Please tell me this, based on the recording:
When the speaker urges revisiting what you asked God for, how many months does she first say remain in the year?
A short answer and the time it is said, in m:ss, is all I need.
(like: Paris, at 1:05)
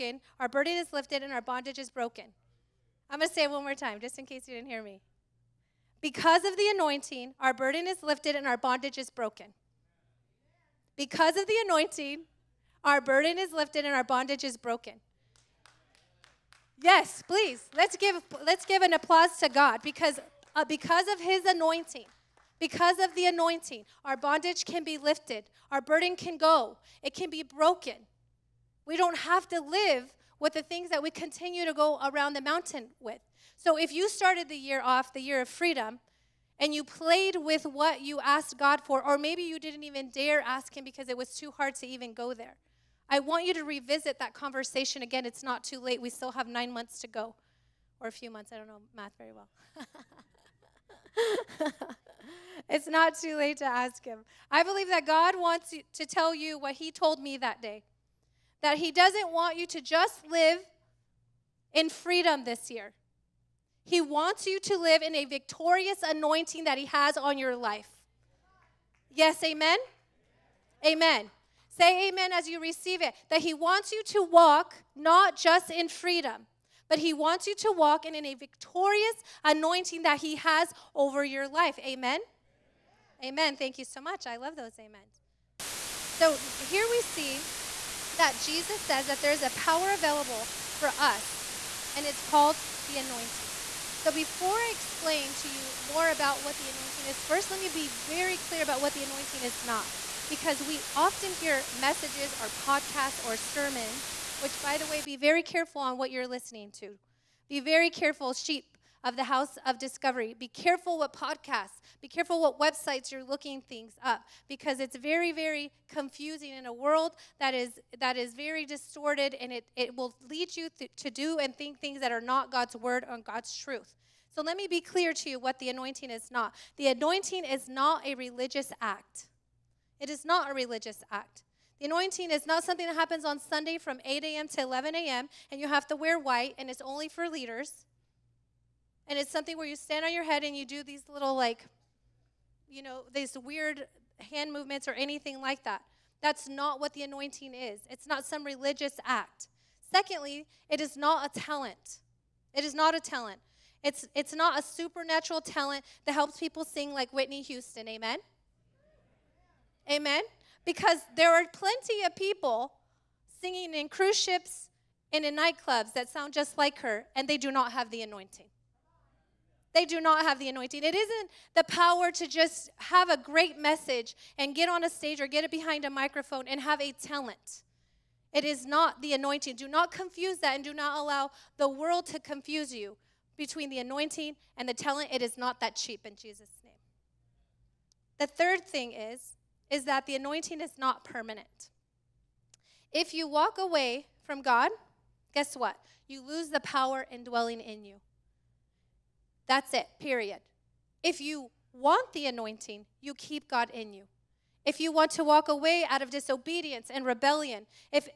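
9, at 0:46.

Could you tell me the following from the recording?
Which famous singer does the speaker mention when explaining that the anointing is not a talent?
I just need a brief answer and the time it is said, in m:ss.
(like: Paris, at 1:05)
Whitney Houston, at 2:37.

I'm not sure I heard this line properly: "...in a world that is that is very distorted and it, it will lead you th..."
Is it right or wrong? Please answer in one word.
right.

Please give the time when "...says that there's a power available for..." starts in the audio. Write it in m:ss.
1:28.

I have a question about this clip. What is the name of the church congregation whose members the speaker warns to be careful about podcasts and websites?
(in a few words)
House of Discovery.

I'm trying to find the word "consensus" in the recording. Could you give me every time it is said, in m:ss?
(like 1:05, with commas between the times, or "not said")
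not said.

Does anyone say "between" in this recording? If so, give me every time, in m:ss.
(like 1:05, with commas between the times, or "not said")
3:03.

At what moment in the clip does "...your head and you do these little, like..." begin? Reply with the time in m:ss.
2:20.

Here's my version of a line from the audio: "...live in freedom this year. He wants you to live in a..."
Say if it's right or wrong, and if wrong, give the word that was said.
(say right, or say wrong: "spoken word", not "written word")
right.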